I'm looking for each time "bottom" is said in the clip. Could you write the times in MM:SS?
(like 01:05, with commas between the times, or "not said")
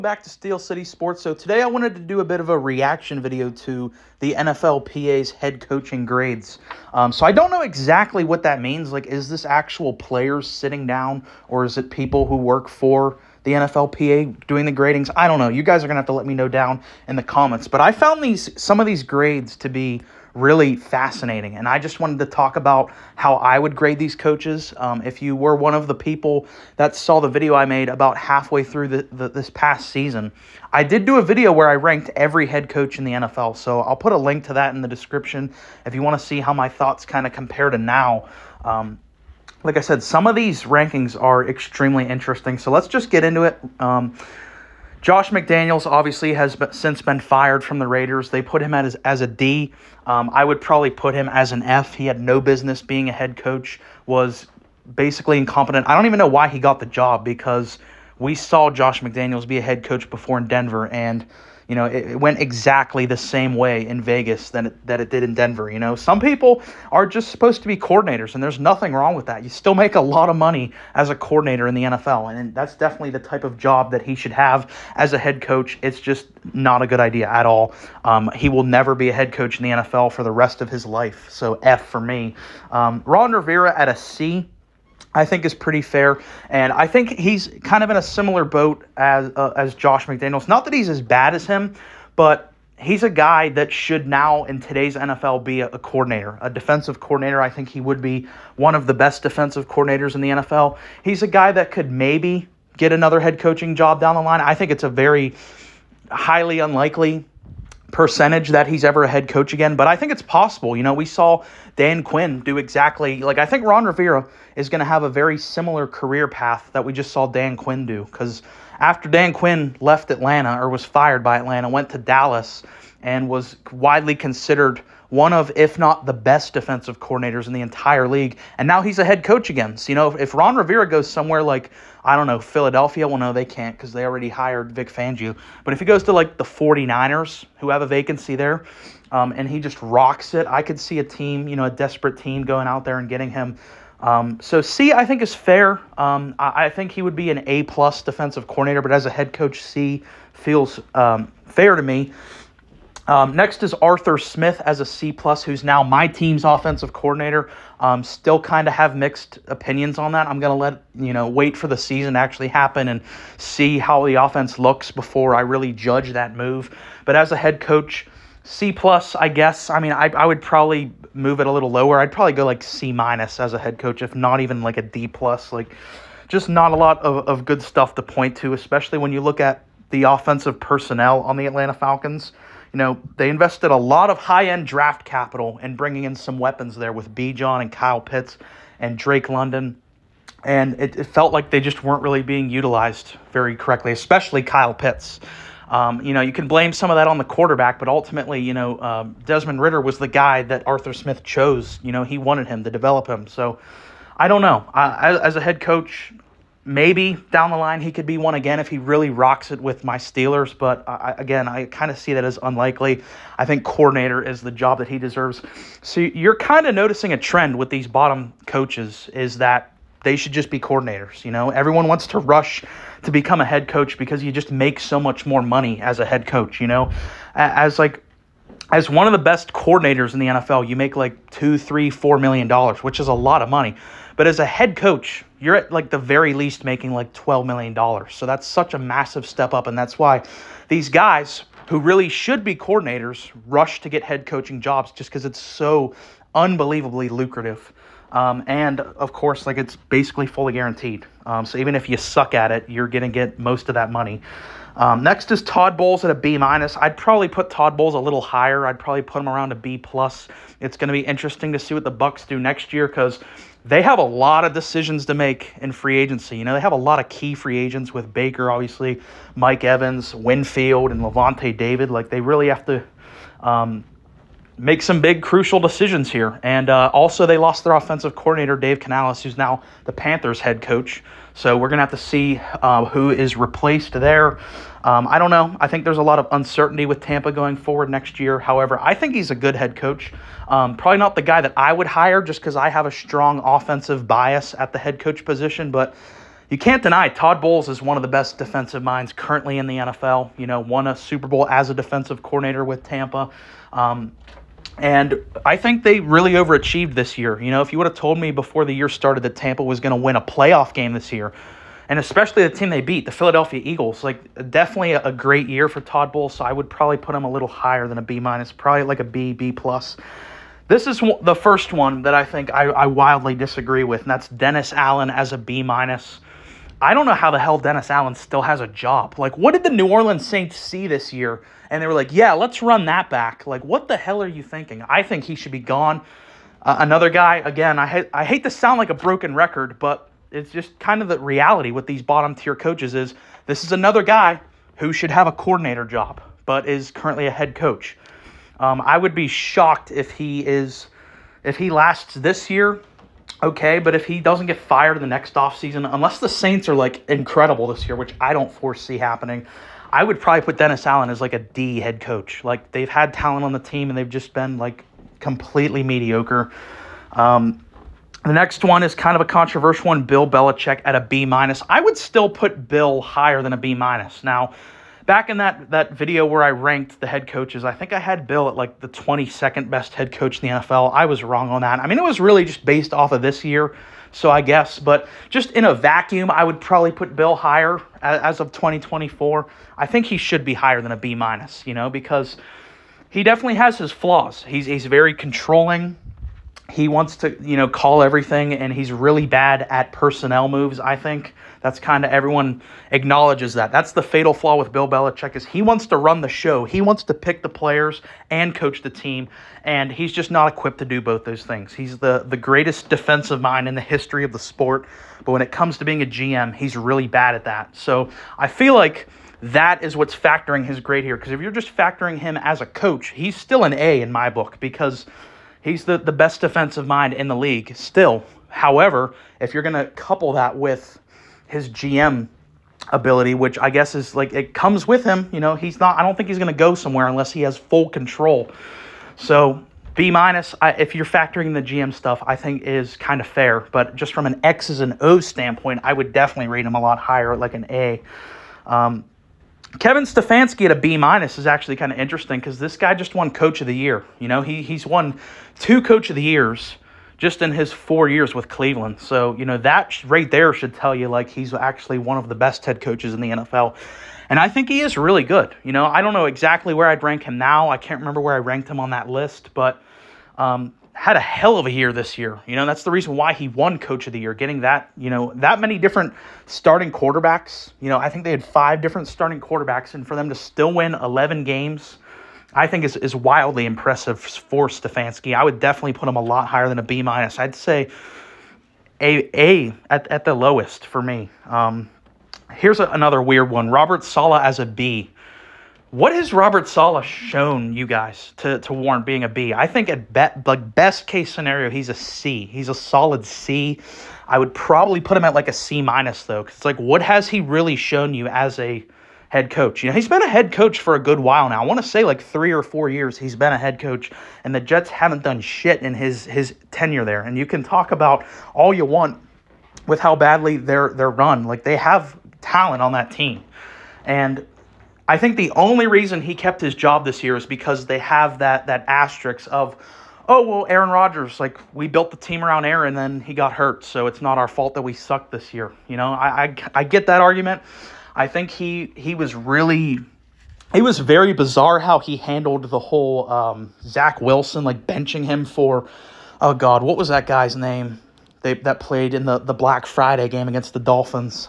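03:37, 05:42.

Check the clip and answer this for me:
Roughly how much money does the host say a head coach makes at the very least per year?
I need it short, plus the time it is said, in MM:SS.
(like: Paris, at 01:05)
$12 million, at 03:57.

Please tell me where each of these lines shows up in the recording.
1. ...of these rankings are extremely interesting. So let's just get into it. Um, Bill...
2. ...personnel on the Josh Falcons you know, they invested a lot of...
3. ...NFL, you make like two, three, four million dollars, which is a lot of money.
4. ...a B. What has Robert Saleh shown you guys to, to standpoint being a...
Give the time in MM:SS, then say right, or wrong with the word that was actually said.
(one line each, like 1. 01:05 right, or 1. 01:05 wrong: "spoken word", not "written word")
1. 00:40 wrong: "Josh", not "Bill"
2. 03:00 wrong: "Atlanta", not "Josh"
3. 03:50 right
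4. 08:14 wrong: "warrant", not "standpoint".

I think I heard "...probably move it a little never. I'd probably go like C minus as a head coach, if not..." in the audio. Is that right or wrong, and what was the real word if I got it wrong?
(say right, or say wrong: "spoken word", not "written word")
wrong: "lower", not "never".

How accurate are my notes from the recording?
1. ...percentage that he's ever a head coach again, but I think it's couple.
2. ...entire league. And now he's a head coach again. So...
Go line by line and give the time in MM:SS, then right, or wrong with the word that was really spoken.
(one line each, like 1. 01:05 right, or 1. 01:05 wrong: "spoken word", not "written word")
1. 01:47 wrong: "possible", not "couple"
2. 02:07 right.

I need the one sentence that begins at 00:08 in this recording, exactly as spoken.
Like, is this actual players sitting down, or is it people who work for the NFLPA doing the gradings?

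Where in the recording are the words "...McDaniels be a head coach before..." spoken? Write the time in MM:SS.
00:59.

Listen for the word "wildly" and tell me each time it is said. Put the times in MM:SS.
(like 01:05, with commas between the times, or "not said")
05:22, 08:03.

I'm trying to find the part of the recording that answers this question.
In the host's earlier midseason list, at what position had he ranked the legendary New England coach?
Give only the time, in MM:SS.
06:18.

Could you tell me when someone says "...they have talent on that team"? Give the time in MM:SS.
08:41.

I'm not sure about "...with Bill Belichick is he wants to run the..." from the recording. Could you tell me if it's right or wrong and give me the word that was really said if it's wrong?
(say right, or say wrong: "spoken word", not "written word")
right.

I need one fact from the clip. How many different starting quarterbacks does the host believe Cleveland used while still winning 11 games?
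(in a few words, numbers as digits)
5.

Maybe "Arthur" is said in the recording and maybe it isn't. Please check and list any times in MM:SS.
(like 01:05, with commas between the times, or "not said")
02:33, 03:20.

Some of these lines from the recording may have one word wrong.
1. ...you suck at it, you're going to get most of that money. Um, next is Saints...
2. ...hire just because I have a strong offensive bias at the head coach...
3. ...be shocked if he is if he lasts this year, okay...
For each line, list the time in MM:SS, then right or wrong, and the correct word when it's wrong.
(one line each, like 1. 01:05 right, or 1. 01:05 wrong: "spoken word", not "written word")
1. 04:11 wrong: "Todd", not "Saints"
2. 04:51 right
3. 05:49 right.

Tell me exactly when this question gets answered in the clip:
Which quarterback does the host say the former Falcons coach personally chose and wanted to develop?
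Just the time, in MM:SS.
03:19.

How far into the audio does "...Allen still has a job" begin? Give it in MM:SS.
05:27.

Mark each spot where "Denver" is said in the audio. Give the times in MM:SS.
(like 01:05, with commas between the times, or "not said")
01:00, 01:05.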